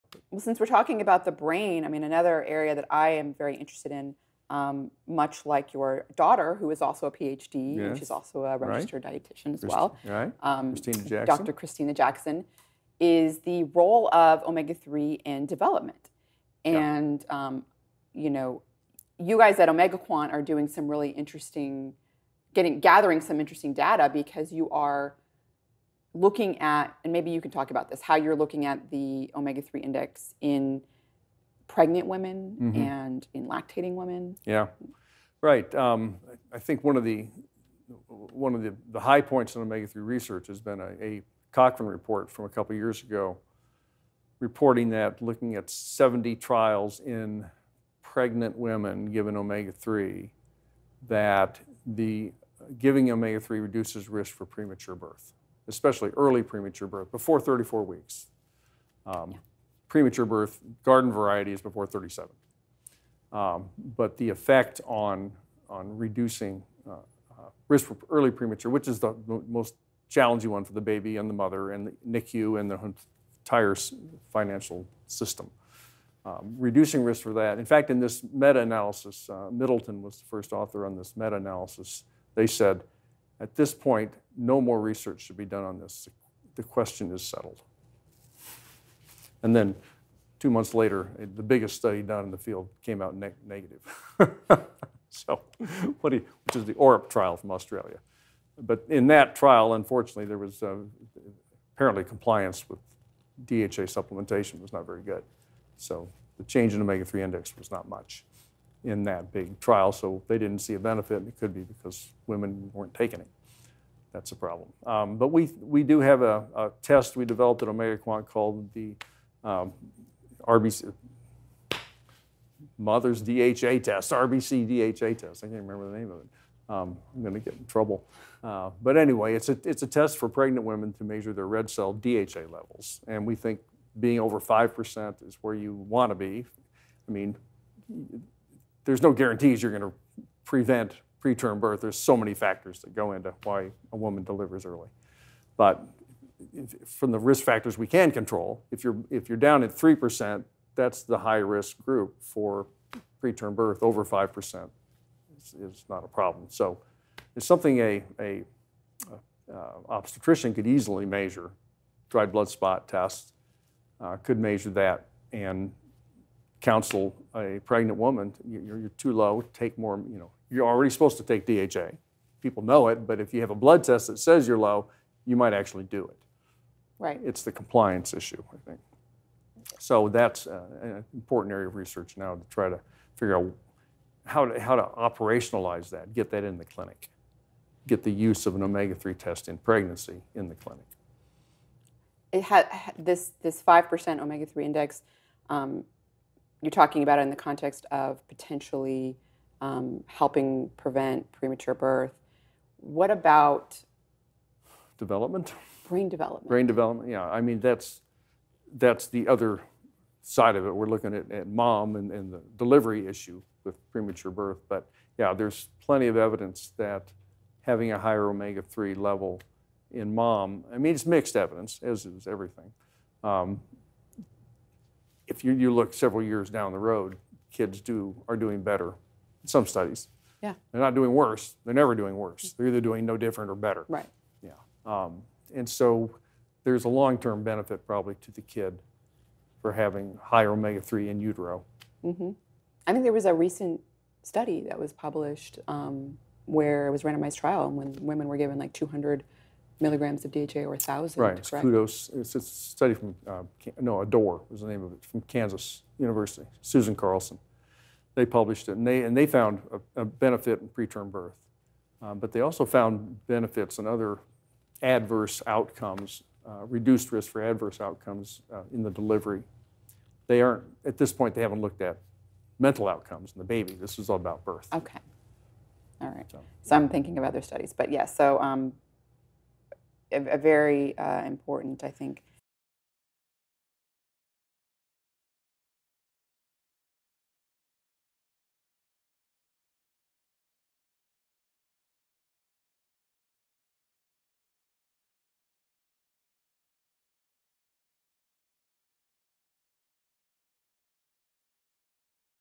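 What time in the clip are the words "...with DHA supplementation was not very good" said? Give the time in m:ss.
1:42.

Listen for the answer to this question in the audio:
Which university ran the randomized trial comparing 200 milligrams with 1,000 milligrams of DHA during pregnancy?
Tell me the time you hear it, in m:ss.
4:15.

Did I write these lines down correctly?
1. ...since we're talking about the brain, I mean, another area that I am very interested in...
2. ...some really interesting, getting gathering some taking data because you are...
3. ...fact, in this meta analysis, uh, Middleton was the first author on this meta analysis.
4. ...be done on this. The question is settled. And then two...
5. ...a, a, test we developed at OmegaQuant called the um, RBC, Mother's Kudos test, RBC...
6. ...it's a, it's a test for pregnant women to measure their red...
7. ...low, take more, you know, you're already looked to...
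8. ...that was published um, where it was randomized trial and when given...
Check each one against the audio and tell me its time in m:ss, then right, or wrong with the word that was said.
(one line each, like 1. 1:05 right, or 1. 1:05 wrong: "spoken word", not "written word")
1. 0:00 right
2. 0:20 wrong: "interesting", not "taking"
3. 1:17 right
4. 1:25 right
5. 1:56 wrong: "DHA", not "Kudos"
6. 2:09 right
7. 2:49 wrong: "supposed", not "looked"
8. 4:04 wrong: "women", not "given".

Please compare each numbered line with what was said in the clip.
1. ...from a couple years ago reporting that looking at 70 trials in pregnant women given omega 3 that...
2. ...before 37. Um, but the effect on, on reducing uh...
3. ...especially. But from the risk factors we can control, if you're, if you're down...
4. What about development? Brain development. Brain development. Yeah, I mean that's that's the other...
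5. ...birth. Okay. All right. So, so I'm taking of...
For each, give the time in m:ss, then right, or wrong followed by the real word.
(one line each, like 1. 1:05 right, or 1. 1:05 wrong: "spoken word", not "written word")
1. 0:42 right
2. 1:01 right
3. 2:24 wrong: "early", not "especially"
4. 3:22 right
5. 4:34 wrong: "thinking", not "taking".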